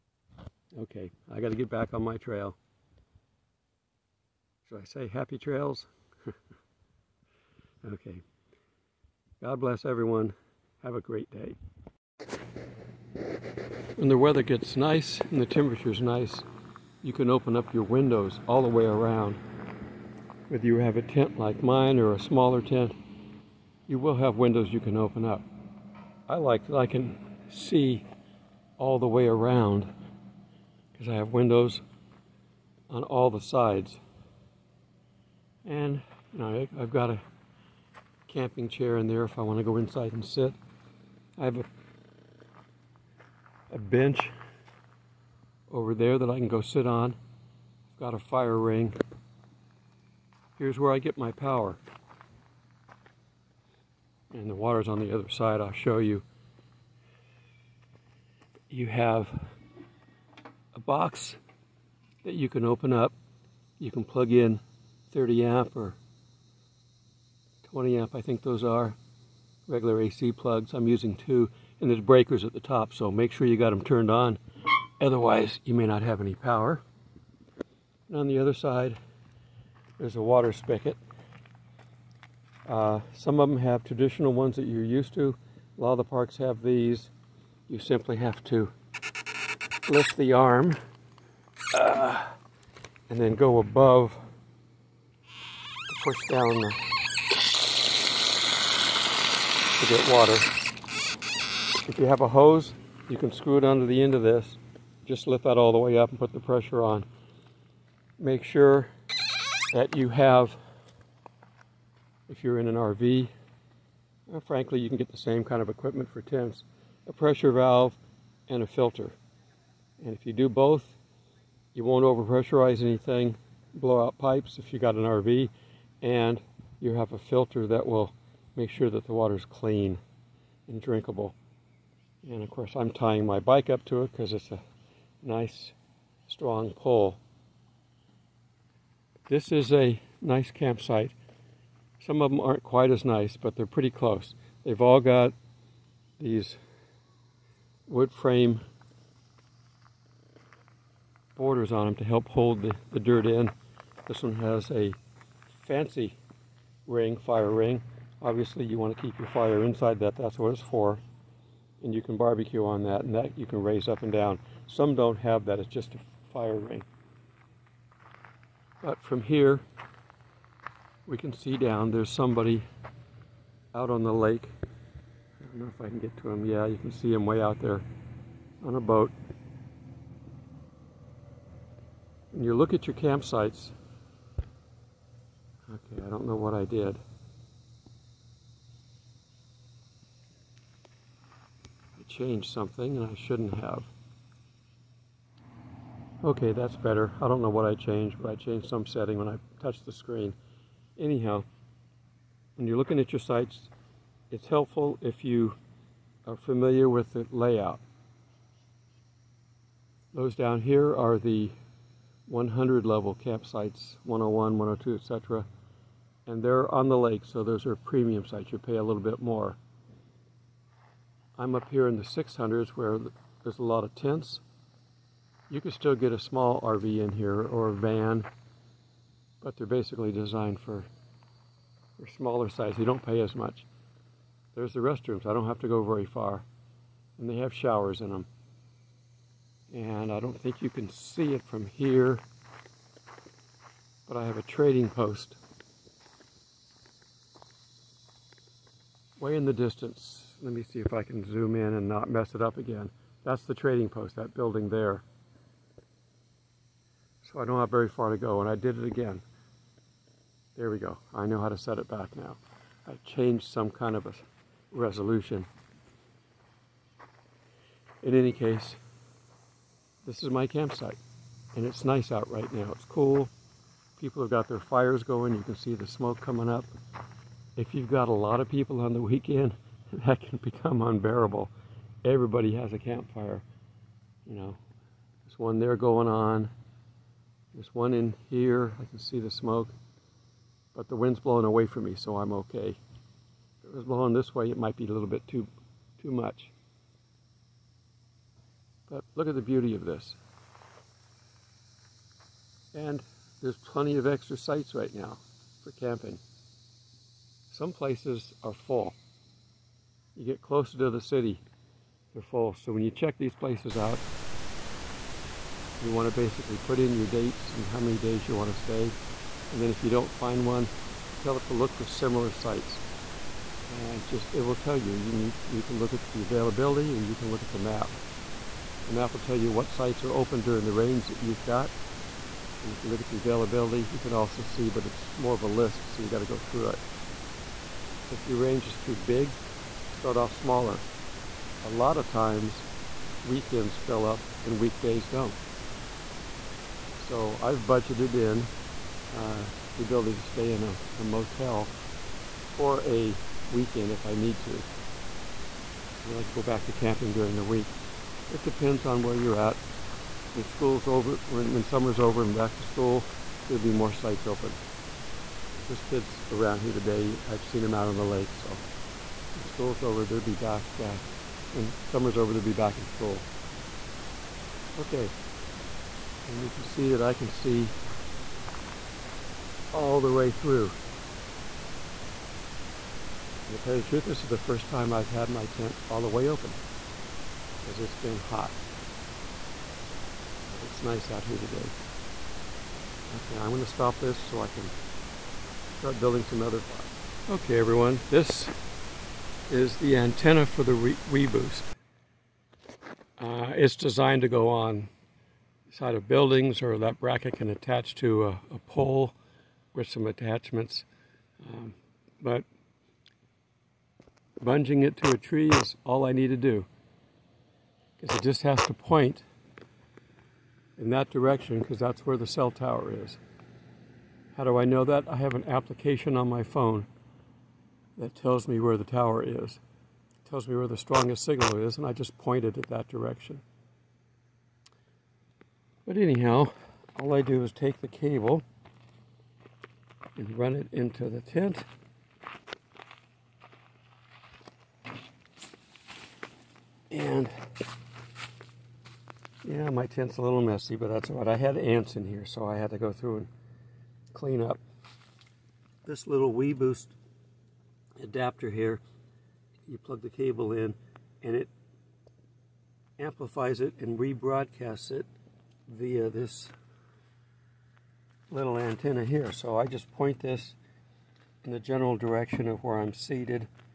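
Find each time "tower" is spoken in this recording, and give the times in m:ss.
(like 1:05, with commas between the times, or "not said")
7:02, 7:08.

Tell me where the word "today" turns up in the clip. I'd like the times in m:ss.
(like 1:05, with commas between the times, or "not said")
6:06, 6:31.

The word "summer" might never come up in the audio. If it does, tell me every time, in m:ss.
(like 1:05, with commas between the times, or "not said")
6:01, 6:11.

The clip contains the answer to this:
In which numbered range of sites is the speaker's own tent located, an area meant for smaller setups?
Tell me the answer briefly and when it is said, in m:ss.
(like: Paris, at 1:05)
600s, at 3:42.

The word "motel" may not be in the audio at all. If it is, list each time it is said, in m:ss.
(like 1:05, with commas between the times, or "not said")
5:51.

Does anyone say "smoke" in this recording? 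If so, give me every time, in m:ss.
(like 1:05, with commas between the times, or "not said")
4:35, 4:49.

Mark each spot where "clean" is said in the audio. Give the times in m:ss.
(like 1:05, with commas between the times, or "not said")
2:09, 7:34.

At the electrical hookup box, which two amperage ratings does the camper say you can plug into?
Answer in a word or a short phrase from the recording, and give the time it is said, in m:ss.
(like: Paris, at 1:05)
30 amp or 20 amp, at 1:05.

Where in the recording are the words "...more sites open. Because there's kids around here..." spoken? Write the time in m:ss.
6:03.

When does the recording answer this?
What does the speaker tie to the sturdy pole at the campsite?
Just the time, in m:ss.
2:13.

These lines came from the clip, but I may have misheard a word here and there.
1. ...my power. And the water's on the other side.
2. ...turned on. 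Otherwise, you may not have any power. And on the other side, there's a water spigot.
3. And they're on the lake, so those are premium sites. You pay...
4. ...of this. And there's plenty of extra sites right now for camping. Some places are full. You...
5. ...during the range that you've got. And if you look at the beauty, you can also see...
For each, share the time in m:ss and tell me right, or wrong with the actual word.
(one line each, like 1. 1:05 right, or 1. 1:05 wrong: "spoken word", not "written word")
1. 0:51 right
2. 1:13 right
3. 3:36 right
4. 4:59 right
5. 5:30 wrong: "availability", not "beauty".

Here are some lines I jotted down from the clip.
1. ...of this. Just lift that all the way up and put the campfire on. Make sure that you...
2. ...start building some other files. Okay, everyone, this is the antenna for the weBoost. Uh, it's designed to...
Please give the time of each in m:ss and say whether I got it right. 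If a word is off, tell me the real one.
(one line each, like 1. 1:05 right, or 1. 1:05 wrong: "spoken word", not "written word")
1. 1:44 wrong: "pressure", not "campfire"
2. 6:35 right.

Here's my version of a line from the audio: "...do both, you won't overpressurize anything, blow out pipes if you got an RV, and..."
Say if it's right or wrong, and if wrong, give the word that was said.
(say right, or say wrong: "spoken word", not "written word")
right.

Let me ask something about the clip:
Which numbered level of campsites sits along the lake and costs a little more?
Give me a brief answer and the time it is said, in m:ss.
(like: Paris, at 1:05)
100 level, at 3:32.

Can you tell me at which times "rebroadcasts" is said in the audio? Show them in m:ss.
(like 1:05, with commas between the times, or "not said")
7:43.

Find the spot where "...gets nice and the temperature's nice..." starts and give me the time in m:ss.
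0:14.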